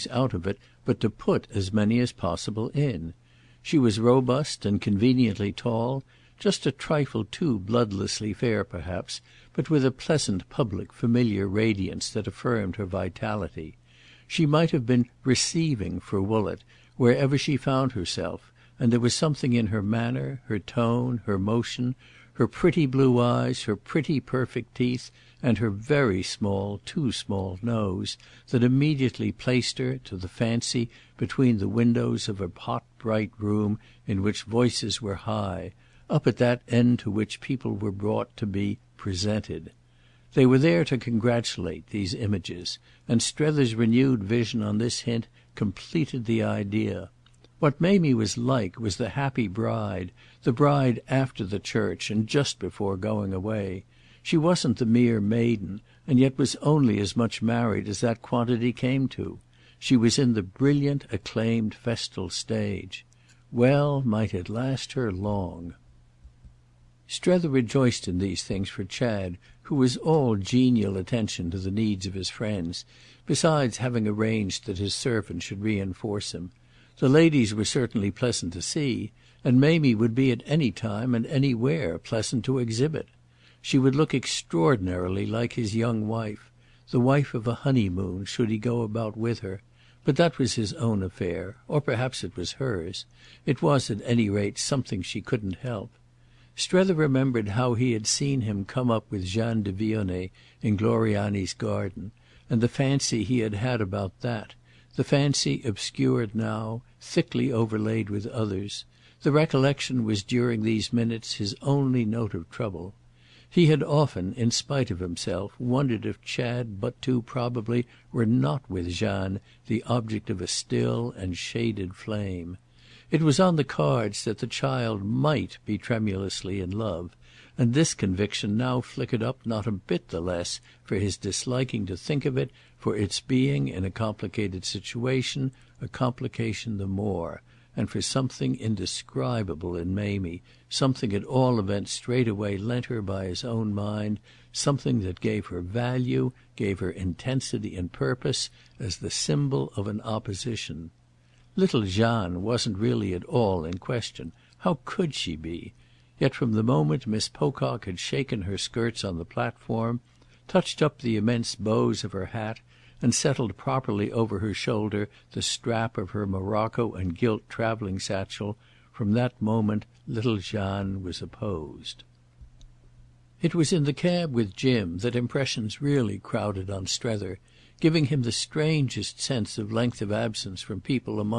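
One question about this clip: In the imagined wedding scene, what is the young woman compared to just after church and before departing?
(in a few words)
the happy bride.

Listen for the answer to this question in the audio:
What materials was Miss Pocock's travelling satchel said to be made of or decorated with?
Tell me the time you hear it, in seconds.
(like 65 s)
166 s.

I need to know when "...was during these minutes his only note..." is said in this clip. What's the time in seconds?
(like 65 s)
110 s.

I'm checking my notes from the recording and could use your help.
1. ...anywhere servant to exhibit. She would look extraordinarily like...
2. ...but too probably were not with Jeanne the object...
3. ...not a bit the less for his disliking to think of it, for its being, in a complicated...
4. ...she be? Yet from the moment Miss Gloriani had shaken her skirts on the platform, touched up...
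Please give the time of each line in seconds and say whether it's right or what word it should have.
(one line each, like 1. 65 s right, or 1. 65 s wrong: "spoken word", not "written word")
1. 81 s wrong: "pleasant", not "servant"
2. 116 s right
3. 129 s right
4. 155 s wrong: "Pocock", not "Gloriani".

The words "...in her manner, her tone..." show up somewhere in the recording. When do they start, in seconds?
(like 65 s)
19 s.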